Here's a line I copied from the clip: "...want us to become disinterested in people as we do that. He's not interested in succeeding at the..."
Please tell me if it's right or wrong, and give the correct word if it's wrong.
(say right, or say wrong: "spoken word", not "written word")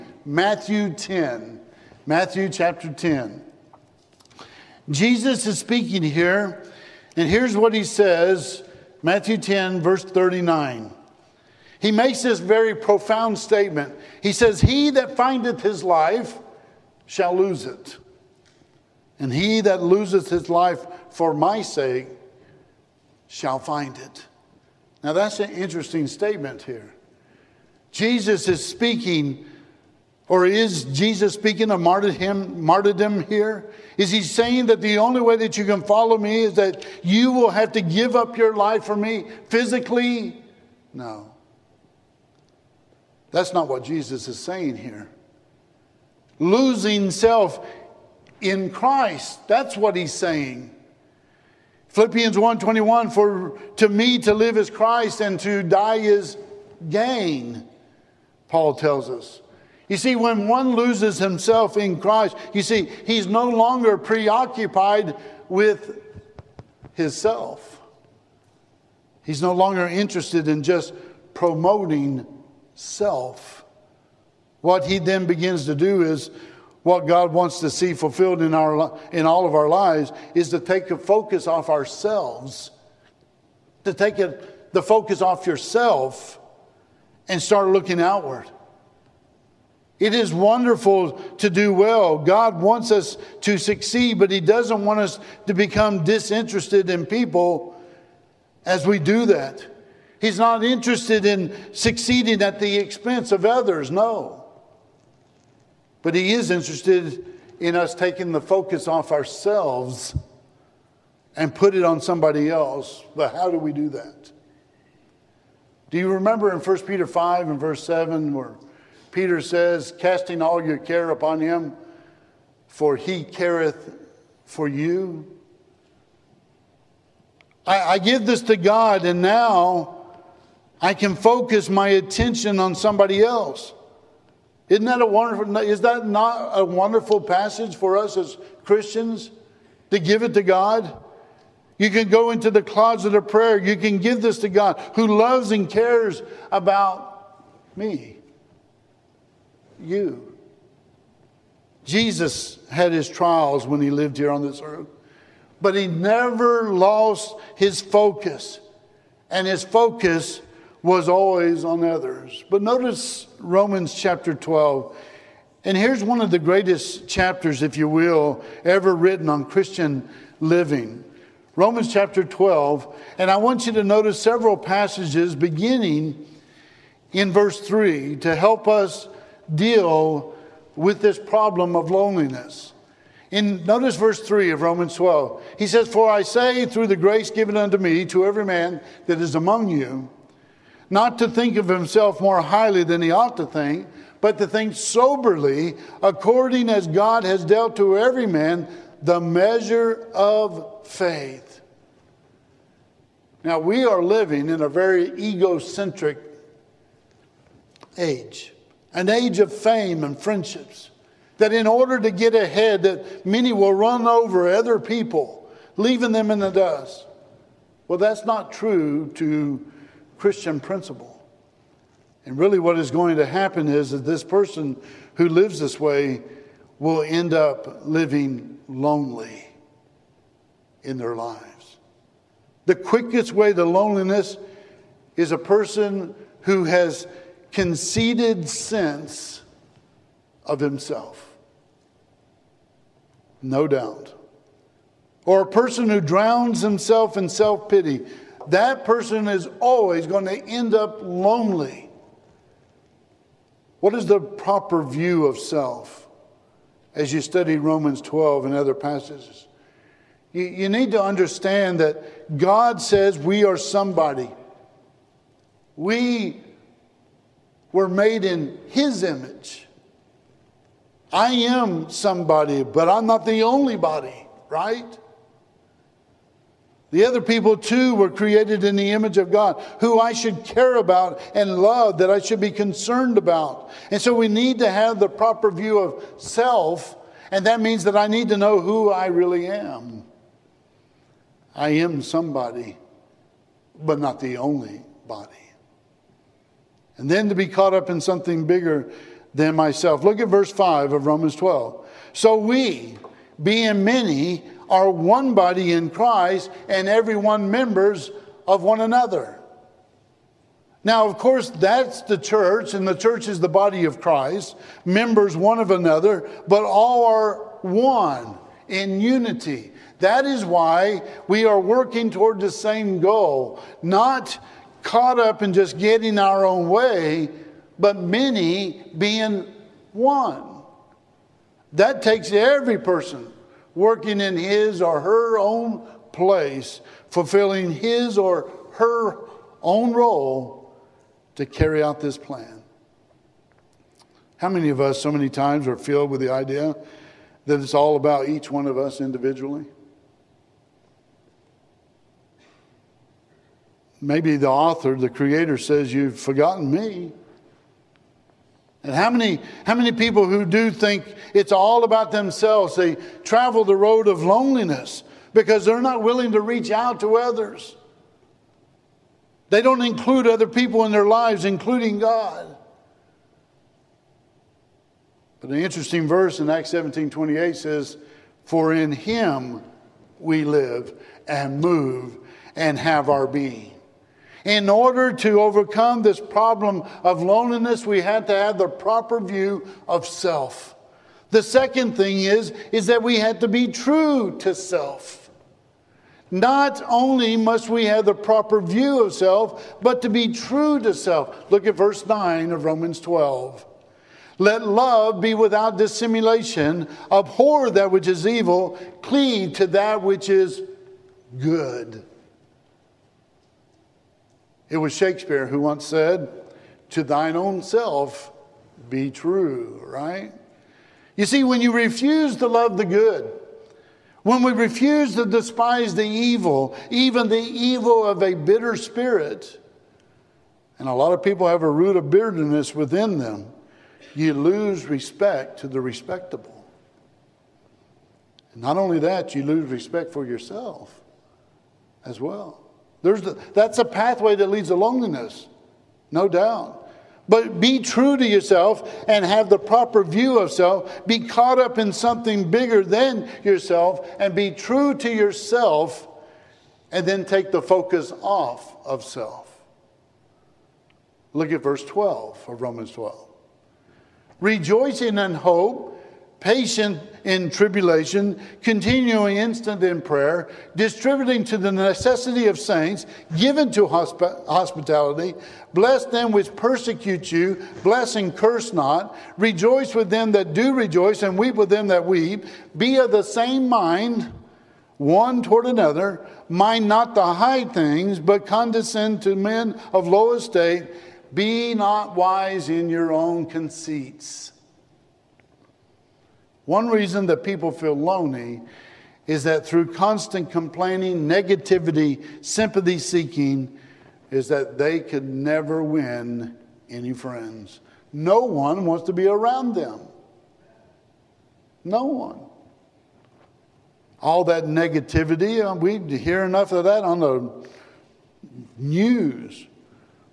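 right.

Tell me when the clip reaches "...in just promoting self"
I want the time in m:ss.
1:10.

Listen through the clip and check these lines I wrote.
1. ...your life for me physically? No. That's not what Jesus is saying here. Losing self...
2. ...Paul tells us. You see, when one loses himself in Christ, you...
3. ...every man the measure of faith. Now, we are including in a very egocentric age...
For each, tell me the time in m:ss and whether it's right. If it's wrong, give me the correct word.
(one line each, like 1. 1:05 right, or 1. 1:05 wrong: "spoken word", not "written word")
1. 0:38 right
2. 0:58 right
3. 3:17 wrong: "living", not "including".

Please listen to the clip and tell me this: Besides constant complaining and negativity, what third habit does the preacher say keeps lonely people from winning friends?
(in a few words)
Sympathy seeking.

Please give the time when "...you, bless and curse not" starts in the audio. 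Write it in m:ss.
7:57.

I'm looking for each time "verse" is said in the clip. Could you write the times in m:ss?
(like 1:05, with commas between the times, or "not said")
0:09, 1:57, 2:57, 3:03, 5:00, 6:16, 6:41, 7:41.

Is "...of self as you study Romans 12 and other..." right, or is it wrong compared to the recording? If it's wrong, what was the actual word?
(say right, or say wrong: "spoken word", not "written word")
right.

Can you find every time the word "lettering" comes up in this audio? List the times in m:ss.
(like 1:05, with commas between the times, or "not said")
not said.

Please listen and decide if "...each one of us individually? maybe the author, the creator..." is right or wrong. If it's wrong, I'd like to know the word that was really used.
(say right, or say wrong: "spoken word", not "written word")
right.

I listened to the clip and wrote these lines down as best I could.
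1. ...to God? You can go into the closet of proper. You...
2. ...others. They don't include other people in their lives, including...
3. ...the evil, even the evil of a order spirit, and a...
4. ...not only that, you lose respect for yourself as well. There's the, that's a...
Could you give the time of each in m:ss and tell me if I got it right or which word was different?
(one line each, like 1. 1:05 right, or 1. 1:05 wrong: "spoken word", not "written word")
1. 2:20 wrong: "prayer", not "proper"
2. 6:07 right
3. 7:05 wrong: "bitter", not "order"
4. 7:18 right.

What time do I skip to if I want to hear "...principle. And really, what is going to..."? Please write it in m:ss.
3:40.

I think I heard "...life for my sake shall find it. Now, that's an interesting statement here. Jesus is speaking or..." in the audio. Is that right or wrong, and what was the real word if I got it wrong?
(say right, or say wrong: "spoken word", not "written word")
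right.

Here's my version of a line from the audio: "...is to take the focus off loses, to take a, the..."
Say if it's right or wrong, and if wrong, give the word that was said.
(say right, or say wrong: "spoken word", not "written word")
wrong: "ourselves", not "loses".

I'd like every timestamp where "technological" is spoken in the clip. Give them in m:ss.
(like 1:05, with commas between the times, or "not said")
not said.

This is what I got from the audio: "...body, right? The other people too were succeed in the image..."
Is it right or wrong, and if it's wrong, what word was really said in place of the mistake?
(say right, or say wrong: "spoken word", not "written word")
wrong: "created", not "succeed".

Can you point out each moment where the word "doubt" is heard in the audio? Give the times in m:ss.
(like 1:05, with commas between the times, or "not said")
4:03, 7:26.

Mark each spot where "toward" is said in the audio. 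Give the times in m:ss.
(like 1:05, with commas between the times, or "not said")
5:22, 8:05.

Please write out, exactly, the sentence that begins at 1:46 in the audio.
But He is interested in us taking the focus off ourselves and put it on somebody else.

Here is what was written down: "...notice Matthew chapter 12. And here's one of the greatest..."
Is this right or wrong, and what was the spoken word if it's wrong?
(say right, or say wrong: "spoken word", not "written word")
wrong: "Romans", not "Matthew".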